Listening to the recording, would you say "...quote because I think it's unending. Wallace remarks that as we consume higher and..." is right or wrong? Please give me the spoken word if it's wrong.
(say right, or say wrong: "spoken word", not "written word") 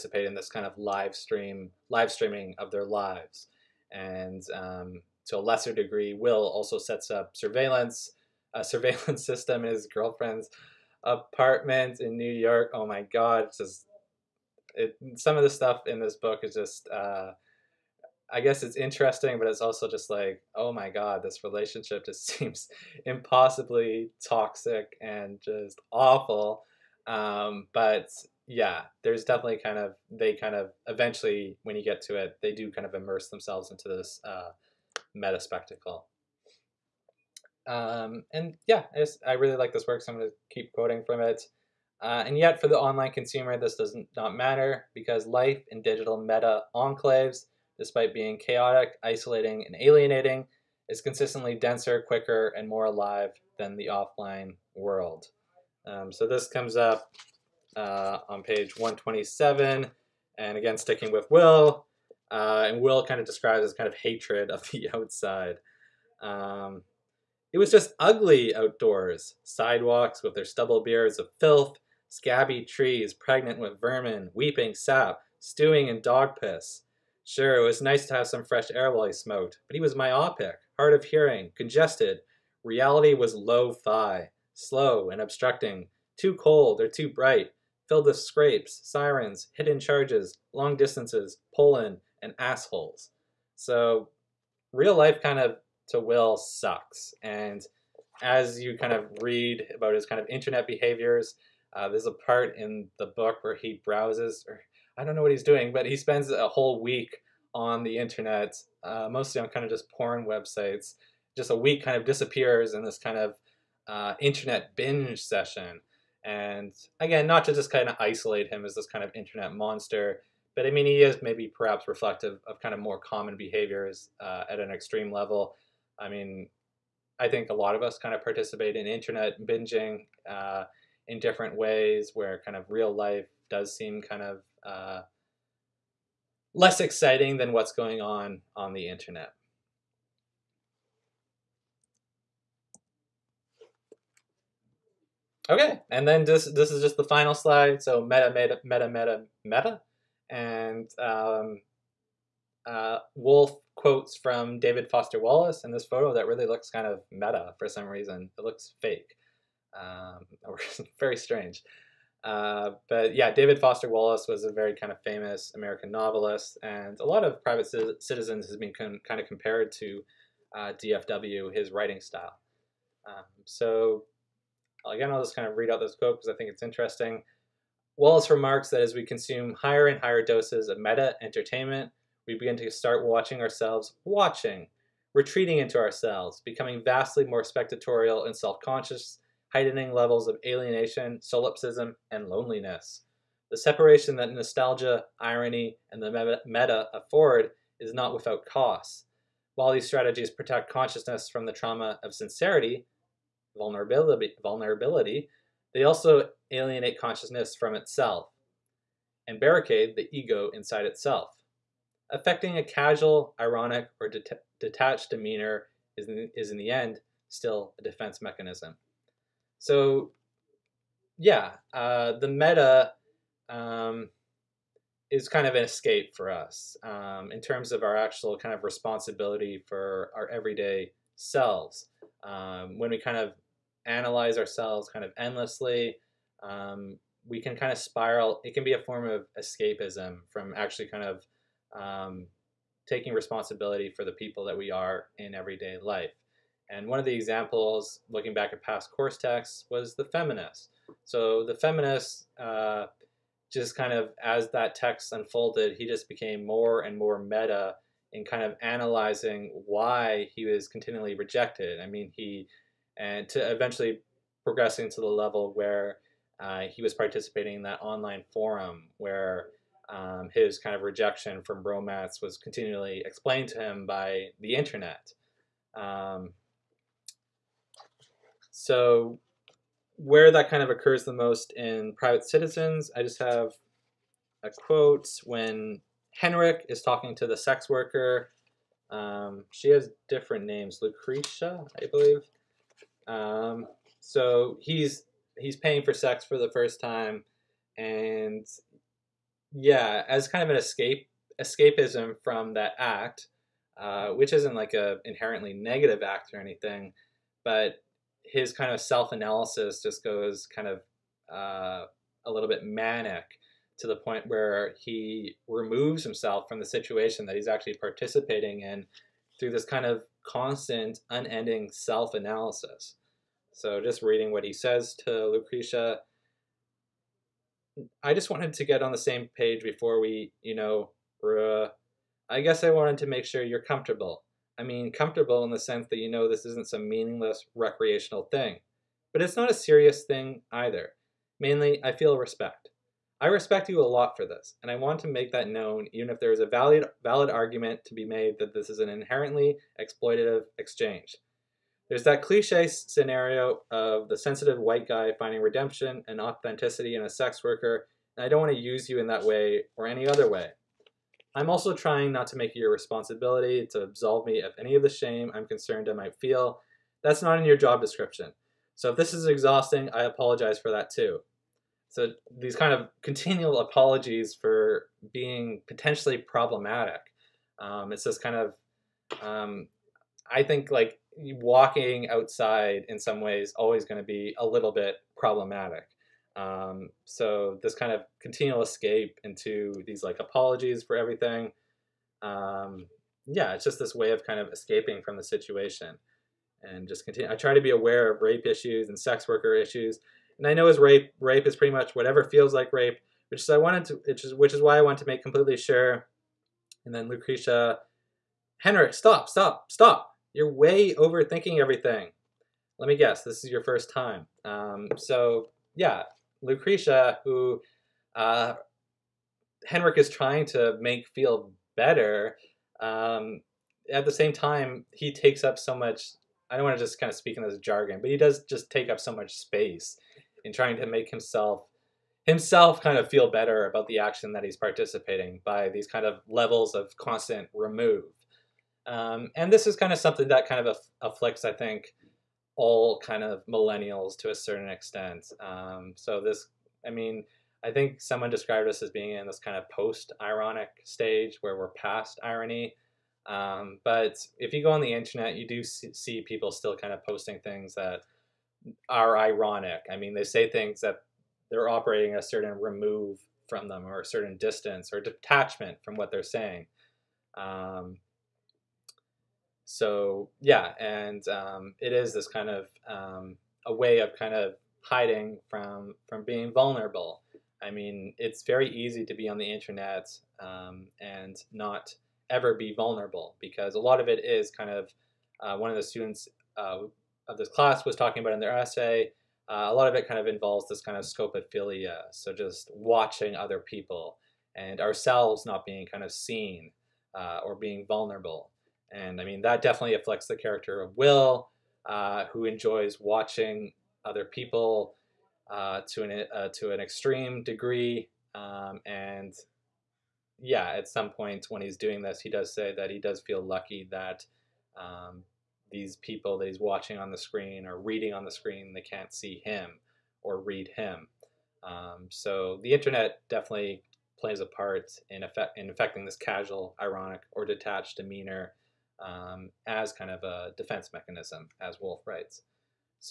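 wrong: "interesting", not "unending".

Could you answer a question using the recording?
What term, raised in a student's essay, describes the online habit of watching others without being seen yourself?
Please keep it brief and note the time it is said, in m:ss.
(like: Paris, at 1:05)
Scopophilia, at 8:11.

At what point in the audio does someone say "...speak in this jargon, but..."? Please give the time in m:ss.
7:07.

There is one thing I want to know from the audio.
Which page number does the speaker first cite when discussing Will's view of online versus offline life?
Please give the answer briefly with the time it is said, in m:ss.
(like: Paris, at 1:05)
127, at 0:58.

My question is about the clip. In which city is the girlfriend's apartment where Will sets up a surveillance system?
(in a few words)
New York.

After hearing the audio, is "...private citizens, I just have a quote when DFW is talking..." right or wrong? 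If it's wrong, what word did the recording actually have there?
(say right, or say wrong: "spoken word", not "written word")
wrong: "Henrik", not "DFW".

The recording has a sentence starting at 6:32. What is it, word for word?
Um, yeah, it's just this way of kind of escaping from the situation and just continue.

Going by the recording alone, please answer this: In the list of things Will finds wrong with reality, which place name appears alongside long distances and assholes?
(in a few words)
Poland.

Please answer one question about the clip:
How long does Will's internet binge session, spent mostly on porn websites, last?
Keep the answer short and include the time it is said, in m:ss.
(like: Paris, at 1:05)
A week, at 1:46.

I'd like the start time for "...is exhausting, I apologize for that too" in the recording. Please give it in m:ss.
6:09.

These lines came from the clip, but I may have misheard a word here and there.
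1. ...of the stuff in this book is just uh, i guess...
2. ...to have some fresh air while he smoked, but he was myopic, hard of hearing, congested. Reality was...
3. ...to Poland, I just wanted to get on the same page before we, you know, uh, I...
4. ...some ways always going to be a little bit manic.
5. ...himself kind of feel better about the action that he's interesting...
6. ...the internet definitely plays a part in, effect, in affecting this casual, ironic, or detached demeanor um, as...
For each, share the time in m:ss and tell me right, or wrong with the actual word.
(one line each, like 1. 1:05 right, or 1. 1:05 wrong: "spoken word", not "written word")
1. 0:15 right
2. 1:18 right
3. 5:25 wrong: "Lucretia", not "Poland"
4. 6:22 wrong: "problematic", not "manic"
5. 7:12 wrong: "participating", not "interesting"
6. 8:42 right.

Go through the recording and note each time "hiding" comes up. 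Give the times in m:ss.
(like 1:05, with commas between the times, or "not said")
7:54.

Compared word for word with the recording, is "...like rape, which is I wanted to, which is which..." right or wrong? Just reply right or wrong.
right.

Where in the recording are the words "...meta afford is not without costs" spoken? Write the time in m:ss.
3:16.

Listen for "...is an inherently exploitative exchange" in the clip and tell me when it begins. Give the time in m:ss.
5:48.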